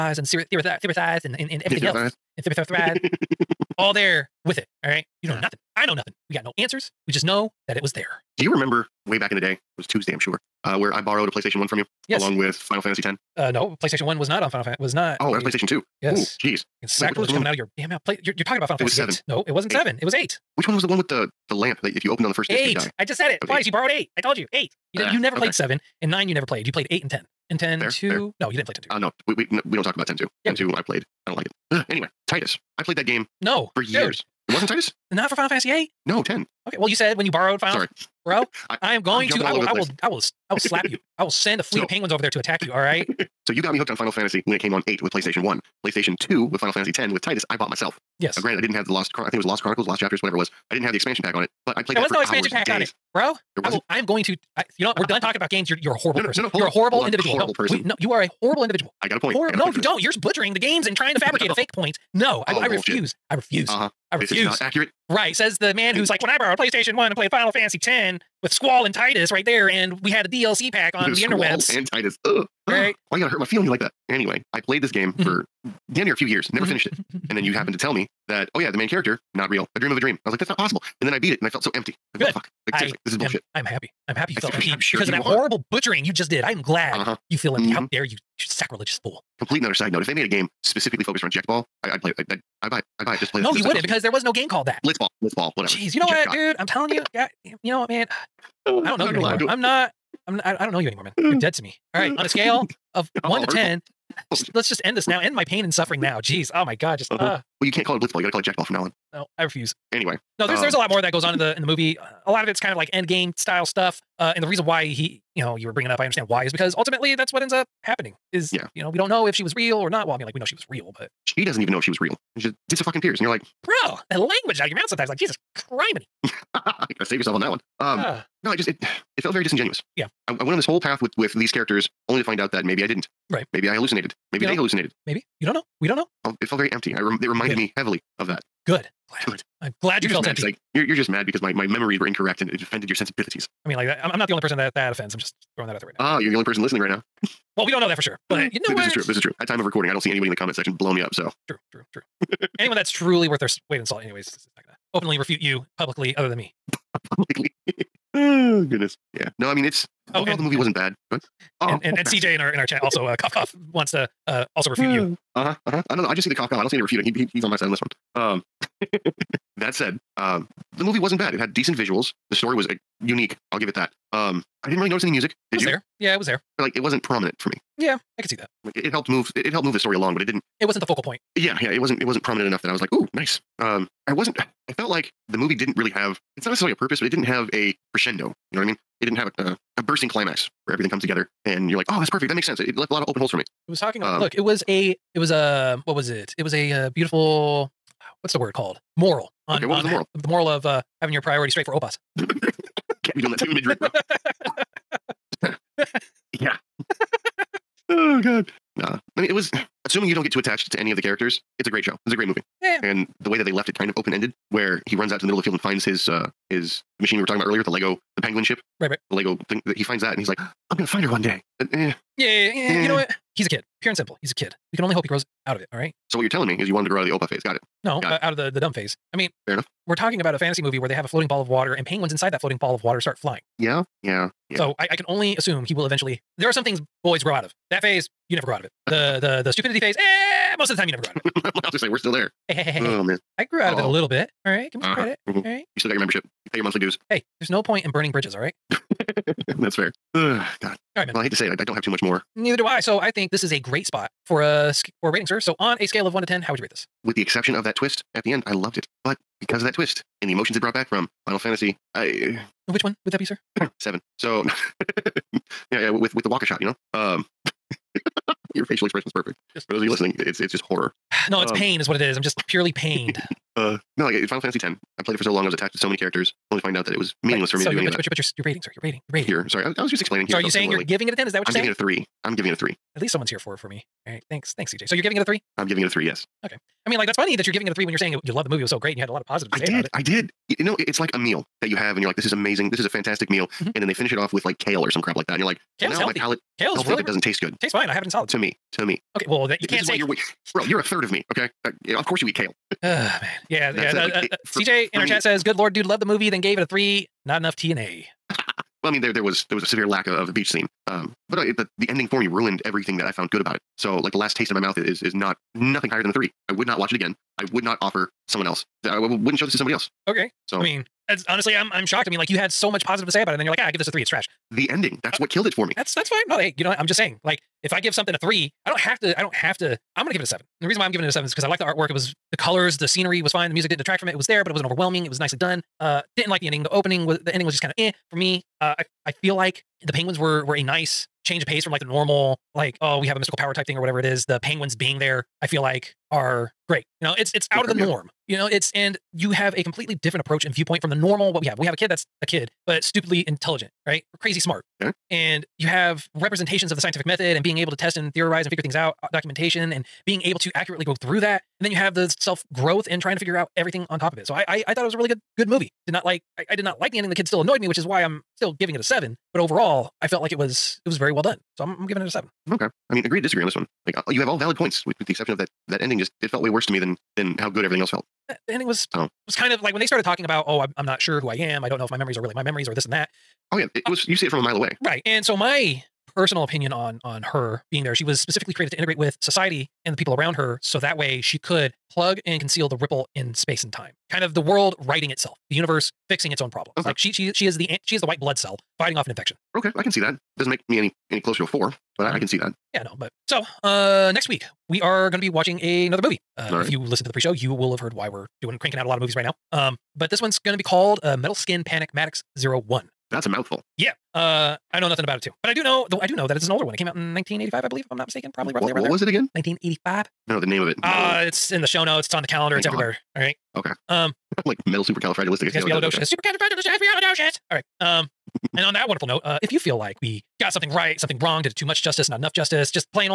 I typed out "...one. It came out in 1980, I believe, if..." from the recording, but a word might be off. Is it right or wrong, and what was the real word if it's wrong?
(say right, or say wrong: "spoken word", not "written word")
wrong: "1985", not "1980".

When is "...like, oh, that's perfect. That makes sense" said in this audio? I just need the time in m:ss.
3:11.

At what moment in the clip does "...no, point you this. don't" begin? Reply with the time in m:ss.
0:59.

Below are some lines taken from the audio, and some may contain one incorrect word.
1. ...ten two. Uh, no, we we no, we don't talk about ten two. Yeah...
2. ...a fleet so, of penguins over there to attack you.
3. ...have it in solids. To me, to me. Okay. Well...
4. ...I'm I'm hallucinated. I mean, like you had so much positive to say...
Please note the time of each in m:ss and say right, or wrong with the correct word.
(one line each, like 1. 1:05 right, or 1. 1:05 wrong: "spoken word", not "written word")
1. 0:28 right
2. 0:41 right
3. 4:57 right
4. 5:21 wrong: "shocked", not "hallucinated".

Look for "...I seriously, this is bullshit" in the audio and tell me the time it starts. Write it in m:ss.
1:22.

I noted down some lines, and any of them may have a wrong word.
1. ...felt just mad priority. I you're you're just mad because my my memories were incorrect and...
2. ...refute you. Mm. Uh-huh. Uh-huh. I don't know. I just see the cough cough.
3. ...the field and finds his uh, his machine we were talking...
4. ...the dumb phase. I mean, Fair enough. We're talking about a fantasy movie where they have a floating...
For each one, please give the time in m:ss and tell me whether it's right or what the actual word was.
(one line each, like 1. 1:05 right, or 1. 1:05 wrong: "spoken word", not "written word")
1. 2:20 wrong: "empty", not "priority"
2. 2:44 right
3. 3:35 right
4. 3:48 right.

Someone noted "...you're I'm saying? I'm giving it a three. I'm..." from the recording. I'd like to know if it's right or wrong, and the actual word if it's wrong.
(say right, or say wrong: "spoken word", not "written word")
right.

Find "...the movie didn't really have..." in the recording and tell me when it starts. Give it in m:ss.
3:05.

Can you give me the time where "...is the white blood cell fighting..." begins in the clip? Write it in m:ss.
6:37.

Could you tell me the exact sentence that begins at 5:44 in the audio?
The penguins being there I feel like are great.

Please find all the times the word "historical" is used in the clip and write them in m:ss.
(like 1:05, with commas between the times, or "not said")
not said.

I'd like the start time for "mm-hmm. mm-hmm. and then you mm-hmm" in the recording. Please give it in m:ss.
1:17.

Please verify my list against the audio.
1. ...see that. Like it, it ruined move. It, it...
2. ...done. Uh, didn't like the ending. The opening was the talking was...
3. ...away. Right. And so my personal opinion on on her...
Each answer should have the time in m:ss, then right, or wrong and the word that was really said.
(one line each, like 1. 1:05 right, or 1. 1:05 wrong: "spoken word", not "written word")
1. 2:58 wrong: "helped", not "ruined"
2. 5:35 wrong: "ending", not "talking"
3. 6:24 right.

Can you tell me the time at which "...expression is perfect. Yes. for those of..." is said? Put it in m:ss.
4:28.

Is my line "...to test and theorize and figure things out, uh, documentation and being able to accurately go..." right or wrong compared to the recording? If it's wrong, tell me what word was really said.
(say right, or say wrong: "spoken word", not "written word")
right.